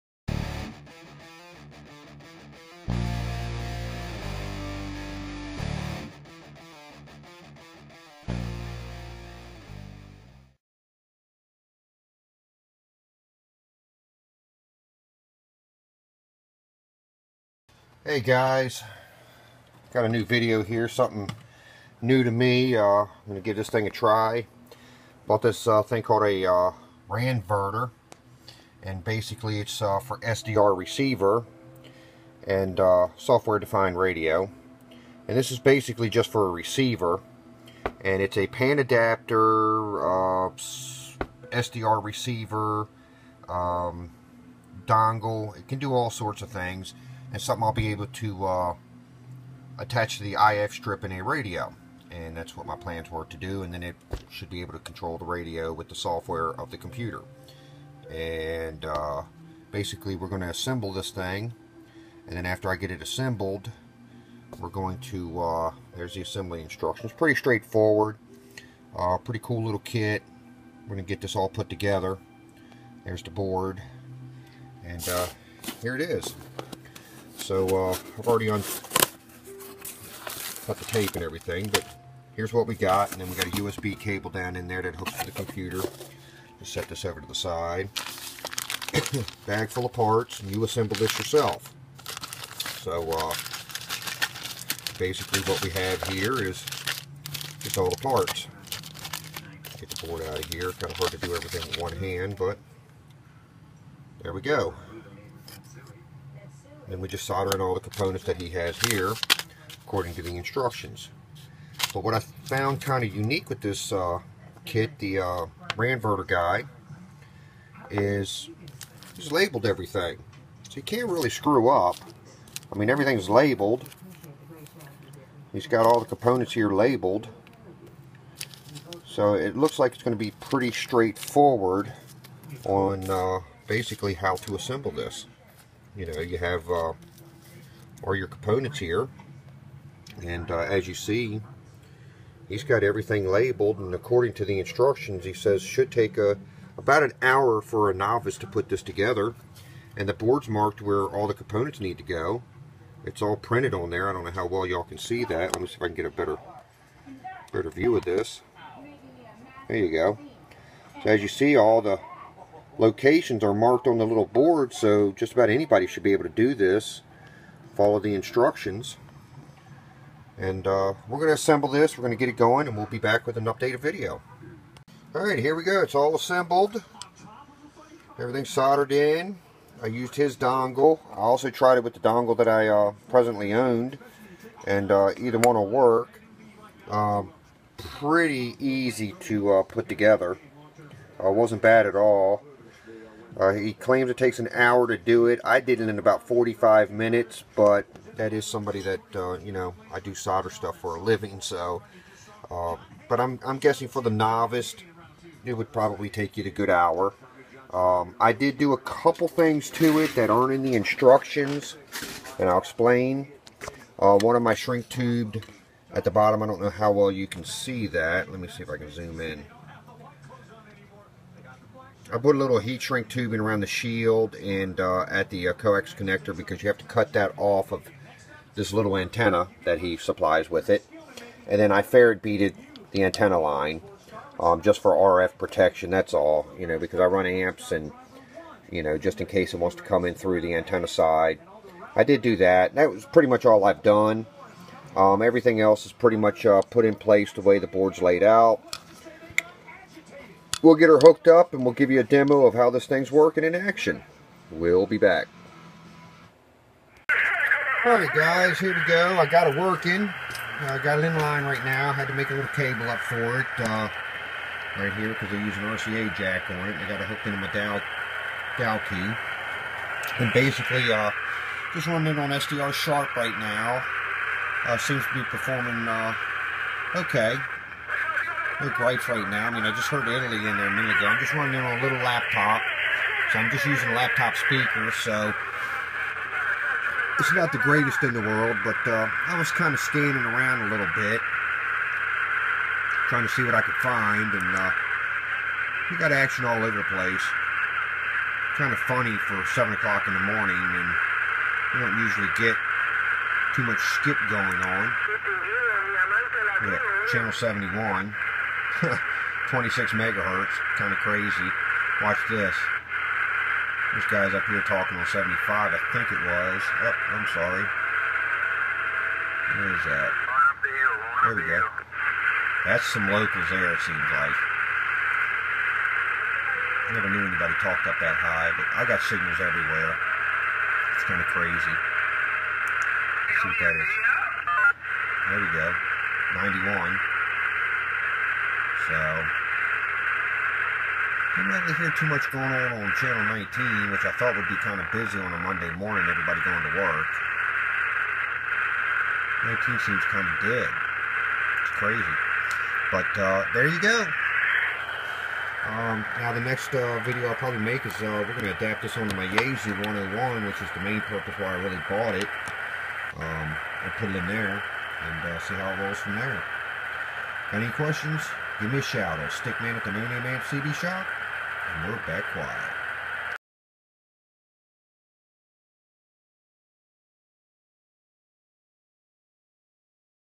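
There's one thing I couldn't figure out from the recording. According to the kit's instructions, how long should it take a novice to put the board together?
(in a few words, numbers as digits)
about an hour.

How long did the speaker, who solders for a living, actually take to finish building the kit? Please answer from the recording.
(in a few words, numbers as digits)
about 45 minutes.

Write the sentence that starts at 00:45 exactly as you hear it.
It can do all sorts of things and something I'll be able to uh, attach to the IF strip in a radio.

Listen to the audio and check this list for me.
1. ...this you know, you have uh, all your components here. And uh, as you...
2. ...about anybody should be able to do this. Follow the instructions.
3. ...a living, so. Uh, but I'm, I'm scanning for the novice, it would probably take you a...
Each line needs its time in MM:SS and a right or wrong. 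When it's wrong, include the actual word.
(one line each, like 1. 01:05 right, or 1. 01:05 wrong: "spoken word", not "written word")
1. 02:14 right
2. 02:45 right
3. 03:20 wrong: "guessing", not "scanning".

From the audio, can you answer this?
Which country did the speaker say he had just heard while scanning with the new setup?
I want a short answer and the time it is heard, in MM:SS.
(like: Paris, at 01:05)
Italy, at 04:40.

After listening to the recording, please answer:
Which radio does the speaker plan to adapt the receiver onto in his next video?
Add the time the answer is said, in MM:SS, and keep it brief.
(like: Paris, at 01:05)
Yaesu 101, at 05:59.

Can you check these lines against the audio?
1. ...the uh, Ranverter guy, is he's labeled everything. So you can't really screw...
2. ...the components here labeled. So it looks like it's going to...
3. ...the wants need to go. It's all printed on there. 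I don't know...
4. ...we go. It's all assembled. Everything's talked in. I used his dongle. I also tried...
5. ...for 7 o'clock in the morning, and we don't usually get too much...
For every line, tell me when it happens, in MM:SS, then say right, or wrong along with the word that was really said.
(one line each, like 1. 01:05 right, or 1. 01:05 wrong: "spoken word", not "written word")
1. 01:54 right
2. 02:05 right
3. 02:31 wrong: "components", not "wants"
4. 02:55 wrong: "soldered", not "talked"
5. 04:59 right.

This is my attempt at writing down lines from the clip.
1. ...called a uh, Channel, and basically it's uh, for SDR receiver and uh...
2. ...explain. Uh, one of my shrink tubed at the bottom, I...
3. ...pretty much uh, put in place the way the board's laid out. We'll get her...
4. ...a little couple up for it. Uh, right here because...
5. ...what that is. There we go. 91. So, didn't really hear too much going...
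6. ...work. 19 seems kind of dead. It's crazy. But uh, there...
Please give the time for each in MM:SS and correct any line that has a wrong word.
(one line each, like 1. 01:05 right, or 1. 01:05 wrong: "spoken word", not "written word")
1. 00:26 wrong: "Ranverter", not "Channel"
2. 03:32 right
3. 04:05 right
4. 04:22 wrong: "cable", not "couple"
5. 05:33 right
6. 05:46 right.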